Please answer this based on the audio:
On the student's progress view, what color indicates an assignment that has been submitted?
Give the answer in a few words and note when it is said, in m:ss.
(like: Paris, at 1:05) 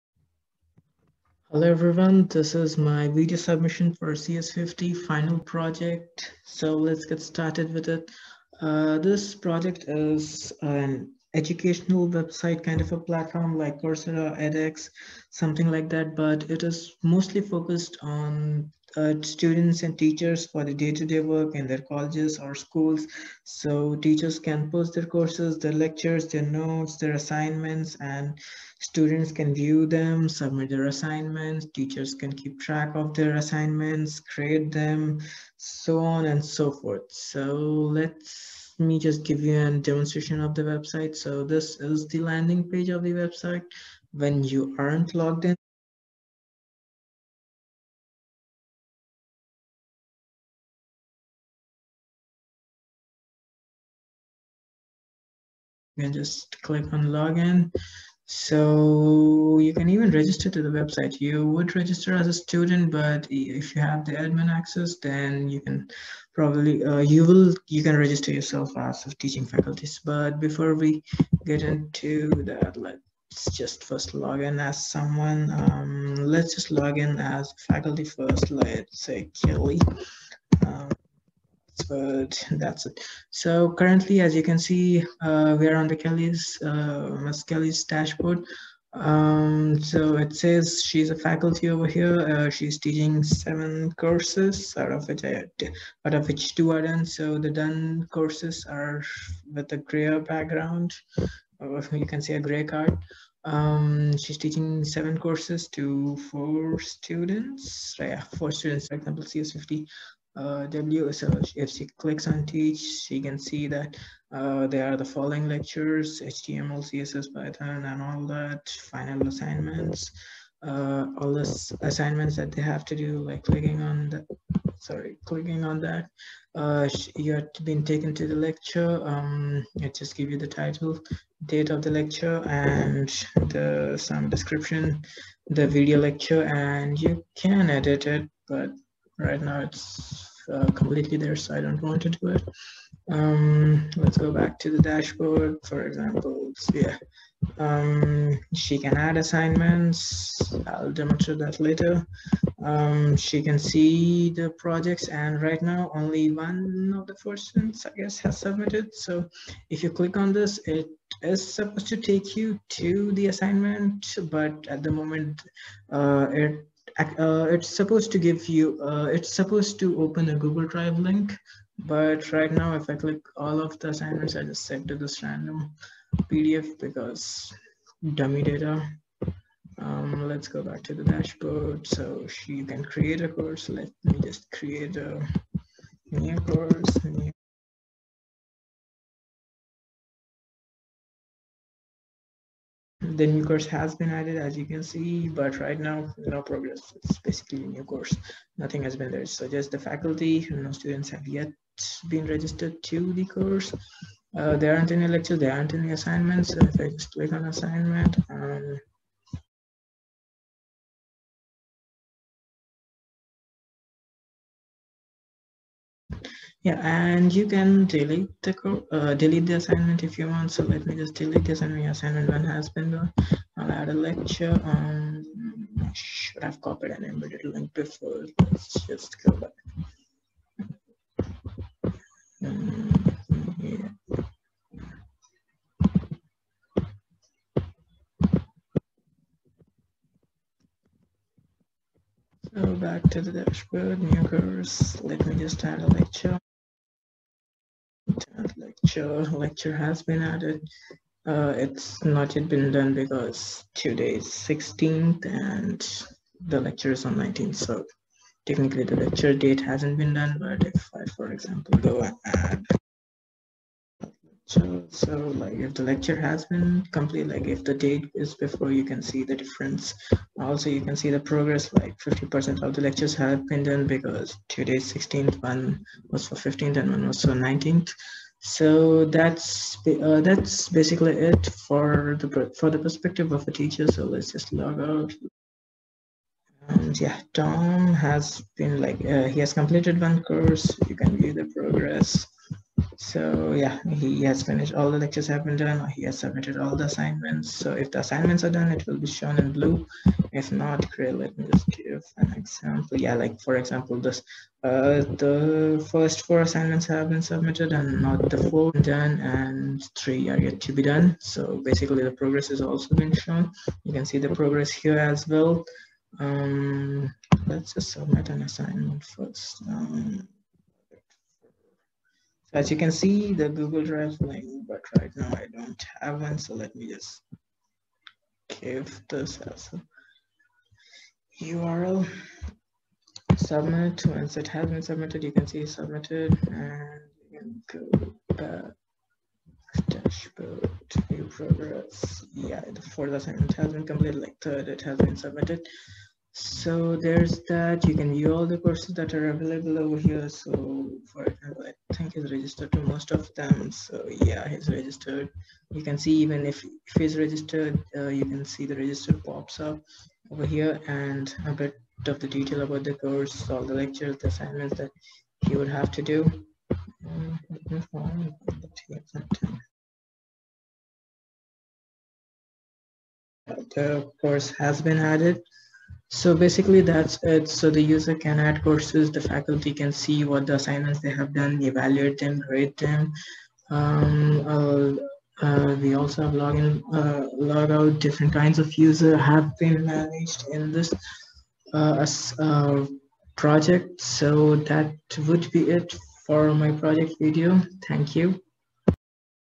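blue, at 4:59.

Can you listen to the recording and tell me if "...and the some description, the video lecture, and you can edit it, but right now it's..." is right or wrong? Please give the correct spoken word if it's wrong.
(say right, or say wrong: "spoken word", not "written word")
right.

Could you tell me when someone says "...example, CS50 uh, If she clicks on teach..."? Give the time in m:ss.
1:48.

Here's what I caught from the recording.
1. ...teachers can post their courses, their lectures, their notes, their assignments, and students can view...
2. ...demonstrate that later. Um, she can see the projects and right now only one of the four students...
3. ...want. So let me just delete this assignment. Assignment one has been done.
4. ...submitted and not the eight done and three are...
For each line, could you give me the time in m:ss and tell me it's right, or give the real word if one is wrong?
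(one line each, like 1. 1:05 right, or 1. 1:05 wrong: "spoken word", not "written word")
1. 0:24 right
2. 2:30 right
3. 3:40 right
4. 5:07 wrong: "four", not "eight".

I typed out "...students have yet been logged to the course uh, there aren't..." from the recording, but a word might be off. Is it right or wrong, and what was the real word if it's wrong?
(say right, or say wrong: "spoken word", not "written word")
wrong: "registered", not "logged".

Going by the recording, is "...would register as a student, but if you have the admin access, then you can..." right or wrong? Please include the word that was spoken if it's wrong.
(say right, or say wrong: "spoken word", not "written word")
right.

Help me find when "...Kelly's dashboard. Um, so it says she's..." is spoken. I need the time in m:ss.
1:27.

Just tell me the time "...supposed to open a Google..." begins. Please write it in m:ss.
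2:49.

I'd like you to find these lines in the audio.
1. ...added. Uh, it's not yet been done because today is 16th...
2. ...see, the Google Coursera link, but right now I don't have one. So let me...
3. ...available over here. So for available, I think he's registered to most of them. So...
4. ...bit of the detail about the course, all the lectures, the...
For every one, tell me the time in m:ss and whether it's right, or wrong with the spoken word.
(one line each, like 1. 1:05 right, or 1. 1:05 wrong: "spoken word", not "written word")
1. 4:10 right
2. 5:22 wrong: "Drive", not "Coursera"
3. 5:49 wrong: "example", not "available"
4. 6:01 right.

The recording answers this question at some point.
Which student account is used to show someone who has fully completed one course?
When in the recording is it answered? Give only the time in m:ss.
4:47.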